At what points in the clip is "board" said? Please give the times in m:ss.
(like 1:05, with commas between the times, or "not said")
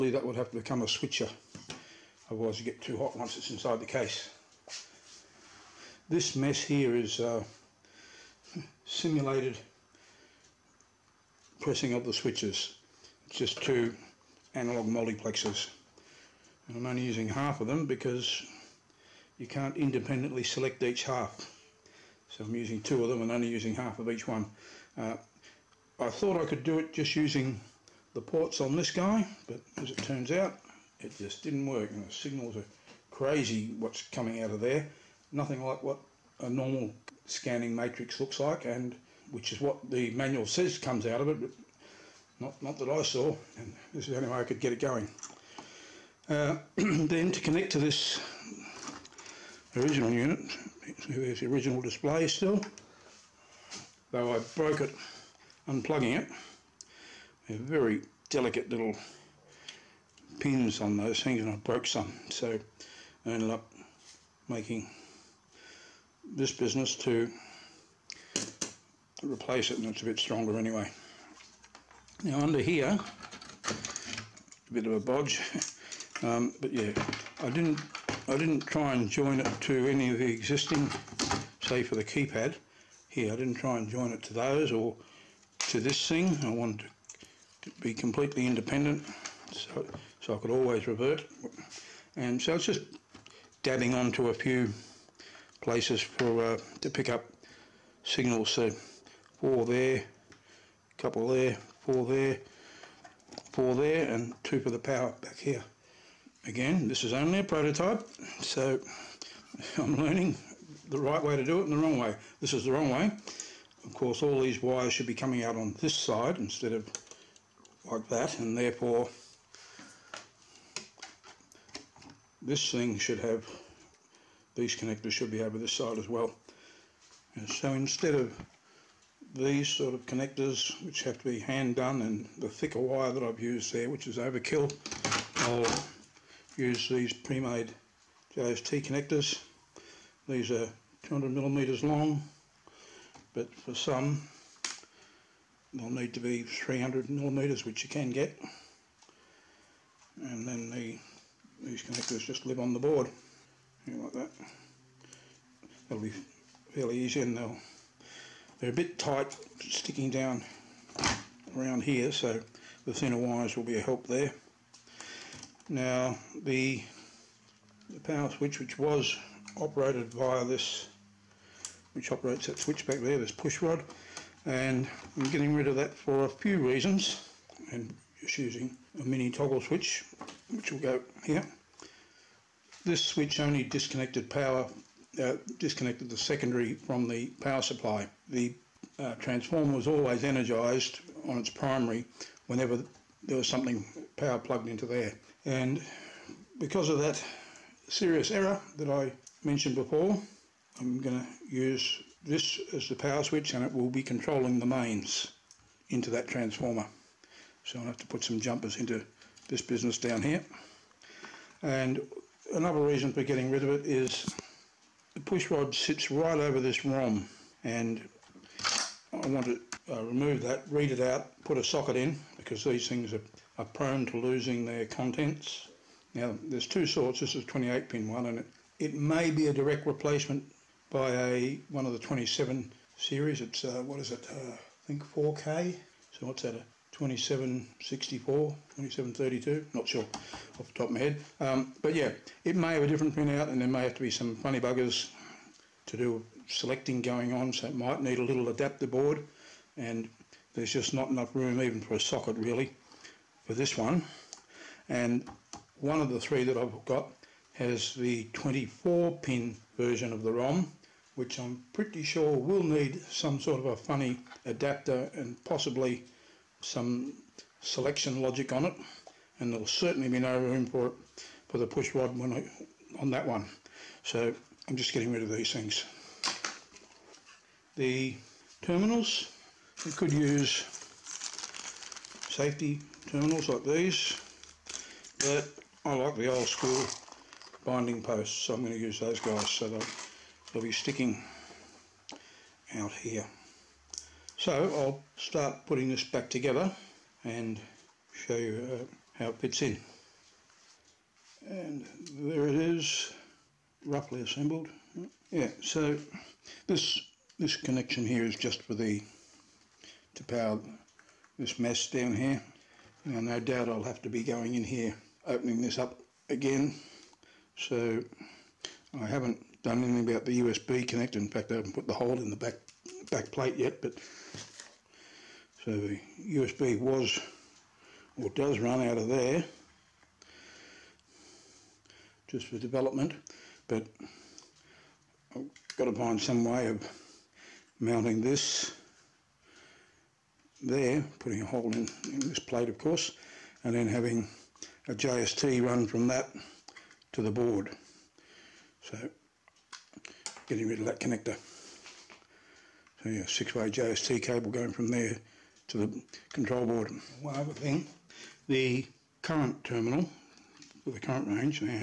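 2:32, 4:08, 5:47, 5:56.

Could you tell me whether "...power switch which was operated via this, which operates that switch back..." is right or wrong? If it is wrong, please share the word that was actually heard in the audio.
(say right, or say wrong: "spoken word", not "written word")
right.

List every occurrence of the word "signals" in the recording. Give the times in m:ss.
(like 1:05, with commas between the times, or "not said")
0:32, 1:38.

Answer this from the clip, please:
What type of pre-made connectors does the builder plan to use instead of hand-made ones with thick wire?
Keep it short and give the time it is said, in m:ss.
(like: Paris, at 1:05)
JST connectors, at 2:18.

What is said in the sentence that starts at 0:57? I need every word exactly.
They're very delicate little pins on those things and I broke some.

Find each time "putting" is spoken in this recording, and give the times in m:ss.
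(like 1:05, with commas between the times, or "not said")
4:55, 5:41.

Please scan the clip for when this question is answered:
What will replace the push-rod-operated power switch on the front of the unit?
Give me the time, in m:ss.
2:59.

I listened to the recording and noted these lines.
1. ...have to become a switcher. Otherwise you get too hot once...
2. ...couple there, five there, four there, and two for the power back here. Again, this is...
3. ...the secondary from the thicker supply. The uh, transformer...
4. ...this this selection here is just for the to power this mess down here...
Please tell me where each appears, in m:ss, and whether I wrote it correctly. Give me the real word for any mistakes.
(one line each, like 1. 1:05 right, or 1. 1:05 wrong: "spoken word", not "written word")
1. 0:00 right
2. 1:40 wrong: "four", not "five"
3. 3:06 wrong: "power", not "thicker"
4. 5:06 wrong: "connection", not "selection".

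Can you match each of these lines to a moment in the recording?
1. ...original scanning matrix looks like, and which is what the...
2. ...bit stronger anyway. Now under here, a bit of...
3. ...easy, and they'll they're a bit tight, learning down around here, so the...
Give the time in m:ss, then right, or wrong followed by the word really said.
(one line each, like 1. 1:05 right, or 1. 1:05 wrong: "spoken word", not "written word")
1. 0:36 wrong: "normal", not "original"
2. 1:10 right
3. 2:36 wrong: "sticking", not "learning".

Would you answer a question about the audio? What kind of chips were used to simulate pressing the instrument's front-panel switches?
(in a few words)
Analog multiplexers.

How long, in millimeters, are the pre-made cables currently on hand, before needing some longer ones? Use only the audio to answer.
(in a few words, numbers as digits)
200.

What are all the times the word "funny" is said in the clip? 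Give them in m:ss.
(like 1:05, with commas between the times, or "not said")
4:04, 4:23.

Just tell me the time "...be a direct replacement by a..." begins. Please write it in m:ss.
3:49.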